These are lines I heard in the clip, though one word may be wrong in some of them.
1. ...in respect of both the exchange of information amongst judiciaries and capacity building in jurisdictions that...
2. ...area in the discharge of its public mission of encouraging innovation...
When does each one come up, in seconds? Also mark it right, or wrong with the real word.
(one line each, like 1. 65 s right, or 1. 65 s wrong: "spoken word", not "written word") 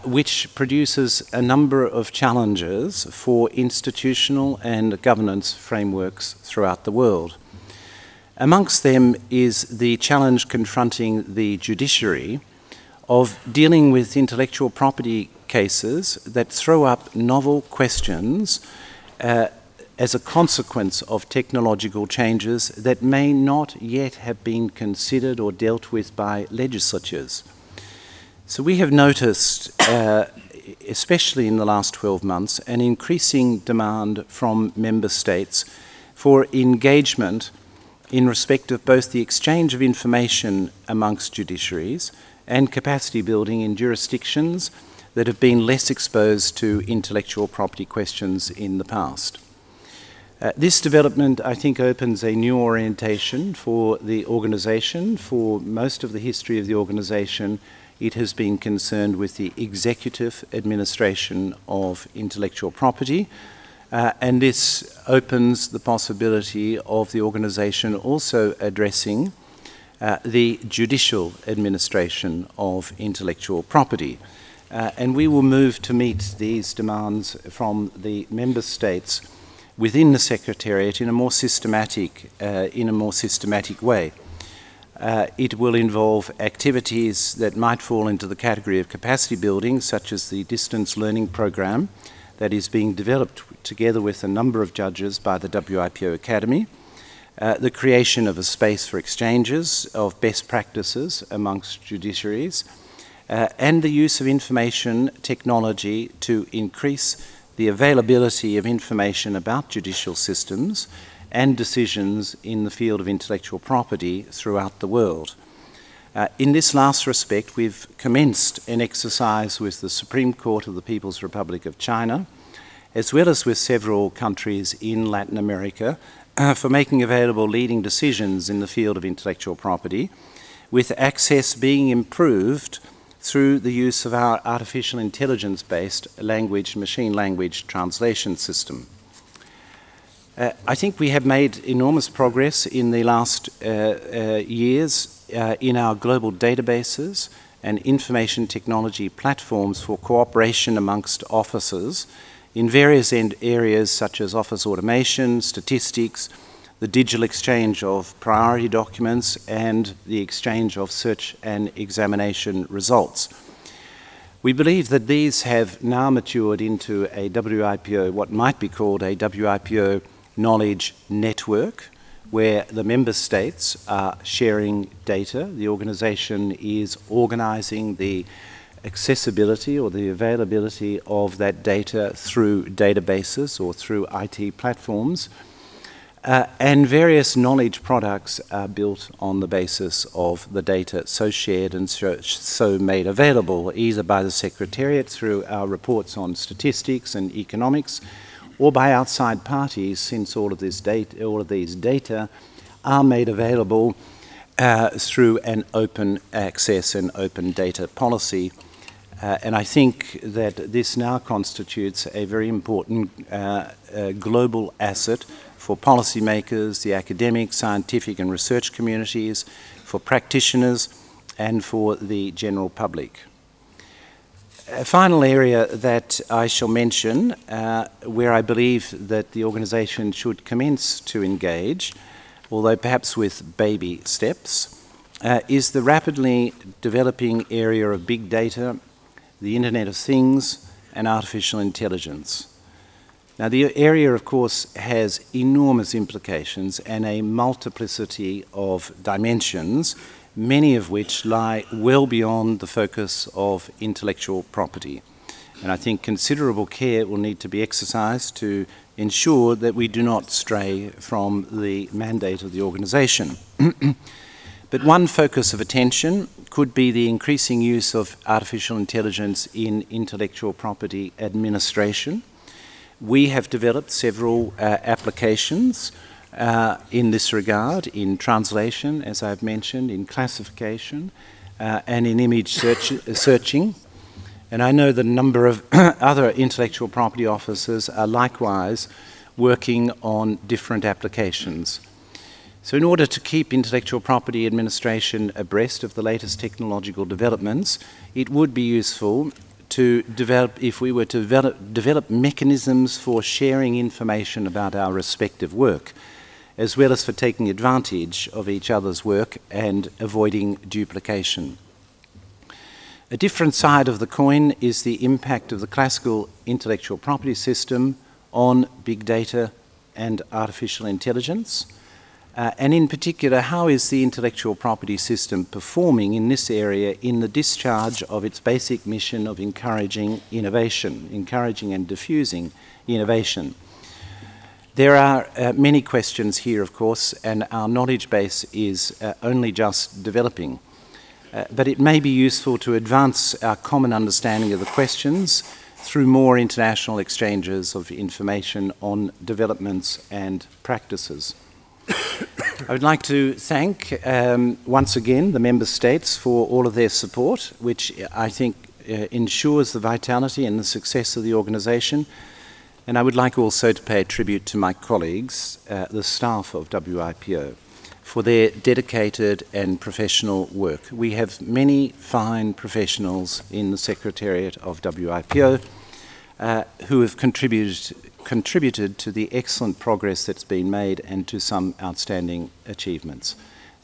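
1. 38 s right
2. 326 s wrong: "basic", not "public".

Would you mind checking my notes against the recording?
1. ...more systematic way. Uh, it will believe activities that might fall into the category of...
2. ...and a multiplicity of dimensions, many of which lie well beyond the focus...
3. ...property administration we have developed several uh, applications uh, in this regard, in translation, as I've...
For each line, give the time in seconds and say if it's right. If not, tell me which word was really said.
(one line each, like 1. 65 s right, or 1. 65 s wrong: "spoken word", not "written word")
1. 82 s wrong: "involve", not "believe"
2. 246 s right
3. 270 s right.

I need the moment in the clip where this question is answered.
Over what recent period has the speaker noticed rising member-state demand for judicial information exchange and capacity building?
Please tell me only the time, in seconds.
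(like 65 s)
31 s.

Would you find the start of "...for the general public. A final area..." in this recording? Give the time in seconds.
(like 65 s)
221 s.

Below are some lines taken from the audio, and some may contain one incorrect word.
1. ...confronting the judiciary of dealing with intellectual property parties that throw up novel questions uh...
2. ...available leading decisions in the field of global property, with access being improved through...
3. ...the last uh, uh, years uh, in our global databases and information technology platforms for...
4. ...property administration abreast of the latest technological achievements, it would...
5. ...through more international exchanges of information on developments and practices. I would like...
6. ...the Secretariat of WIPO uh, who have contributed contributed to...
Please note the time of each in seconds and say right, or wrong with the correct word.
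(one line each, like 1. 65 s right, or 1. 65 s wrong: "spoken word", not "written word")
1. 10 s wrong: "cases", not "parties"
2. 127 s wrong: "intellectual", not "global"
3. 142 s right
4. 294 s wrong: "developments", not "achievements"
5. 345 s right
6. 373 s right.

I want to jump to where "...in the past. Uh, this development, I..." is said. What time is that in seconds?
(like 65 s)
48 s.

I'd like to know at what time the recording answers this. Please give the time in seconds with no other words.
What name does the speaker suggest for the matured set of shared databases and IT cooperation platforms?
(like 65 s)
169 s.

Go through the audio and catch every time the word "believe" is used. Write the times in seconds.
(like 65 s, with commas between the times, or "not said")
164 s, 228 s.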